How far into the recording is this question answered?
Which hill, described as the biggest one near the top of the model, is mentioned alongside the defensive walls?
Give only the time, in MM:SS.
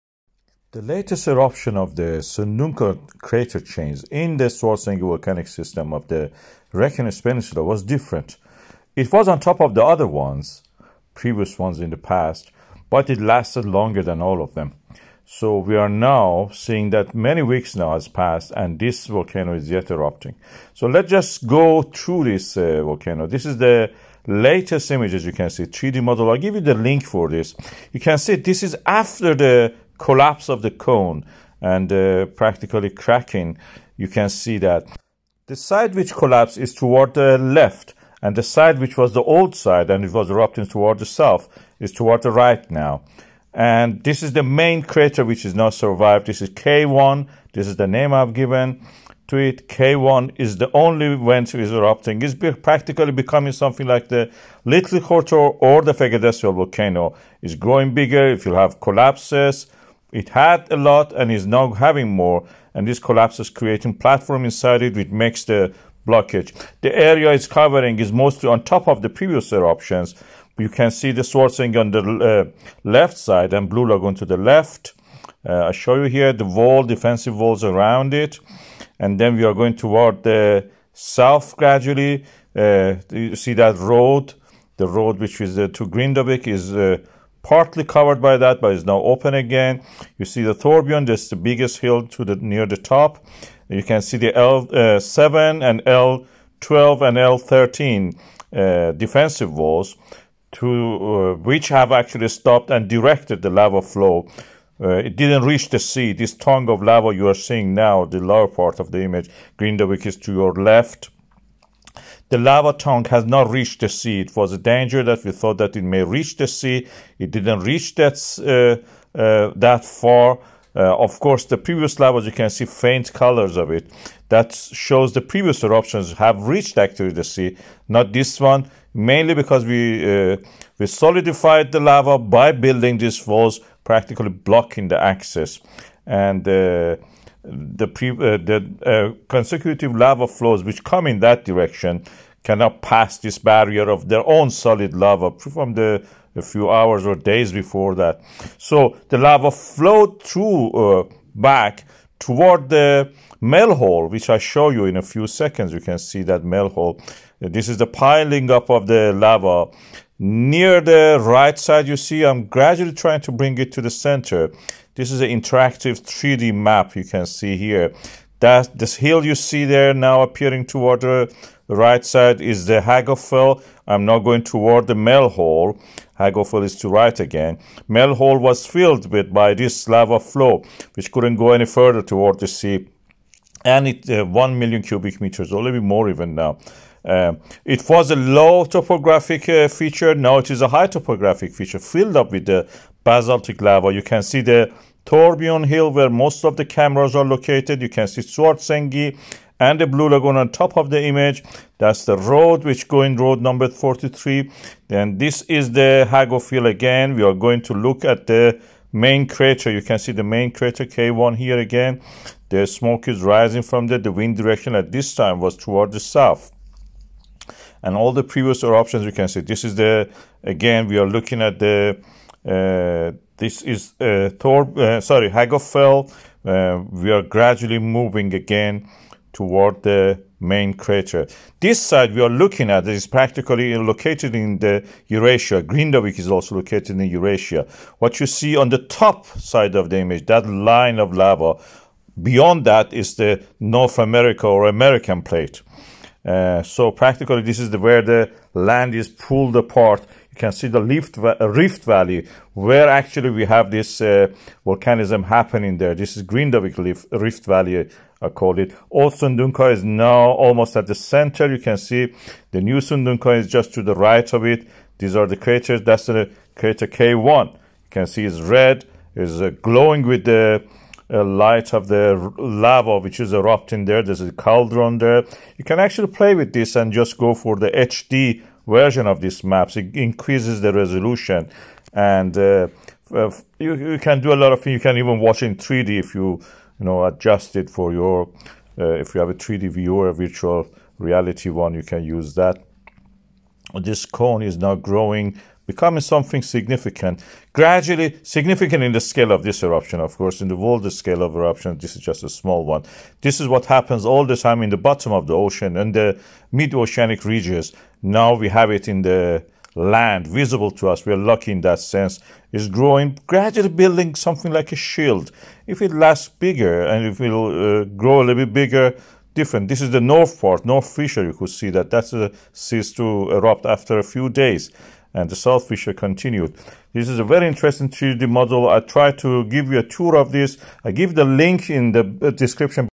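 01:30.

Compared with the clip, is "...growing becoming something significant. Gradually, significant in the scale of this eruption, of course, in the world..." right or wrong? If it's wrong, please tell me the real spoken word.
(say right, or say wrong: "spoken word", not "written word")
right.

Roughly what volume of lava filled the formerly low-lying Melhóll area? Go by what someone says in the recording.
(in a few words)
1 million cubic meters.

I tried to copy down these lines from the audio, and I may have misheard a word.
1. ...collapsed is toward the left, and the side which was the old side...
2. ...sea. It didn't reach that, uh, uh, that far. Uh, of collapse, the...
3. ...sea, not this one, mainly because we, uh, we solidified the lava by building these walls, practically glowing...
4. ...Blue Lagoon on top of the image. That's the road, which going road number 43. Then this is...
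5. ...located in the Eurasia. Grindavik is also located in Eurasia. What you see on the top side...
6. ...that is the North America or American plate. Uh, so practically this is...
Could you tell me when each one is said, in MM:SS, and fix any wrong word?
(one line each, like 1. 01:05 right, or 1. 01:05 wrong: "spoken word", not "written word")
1. 00:36 right
2. 01:56 wrong: "course", not "collapse"
3. 02:07 wrong: "blocking", not "glowing"
4. 03:19 right
5. 03:53 right
6. 04:02 right.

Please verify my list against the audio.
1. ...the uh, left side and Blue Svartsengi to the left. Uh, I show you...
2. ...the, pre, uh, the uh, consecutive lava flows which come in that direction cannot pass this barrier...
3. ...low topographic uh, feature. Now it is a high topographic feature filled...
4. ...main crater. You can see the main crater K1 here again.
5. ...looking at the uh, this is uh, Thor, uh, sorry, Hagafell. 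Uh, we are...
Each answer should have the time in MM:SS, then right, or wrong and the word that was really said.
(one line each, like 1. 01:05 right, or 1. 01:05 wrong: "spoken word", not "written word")
1. 01:11 wrong: "Lagoon", not "Svartsengi"
2. 02:17 right
3. 03:08 right
4. 03:28 right
5. 03:41 right.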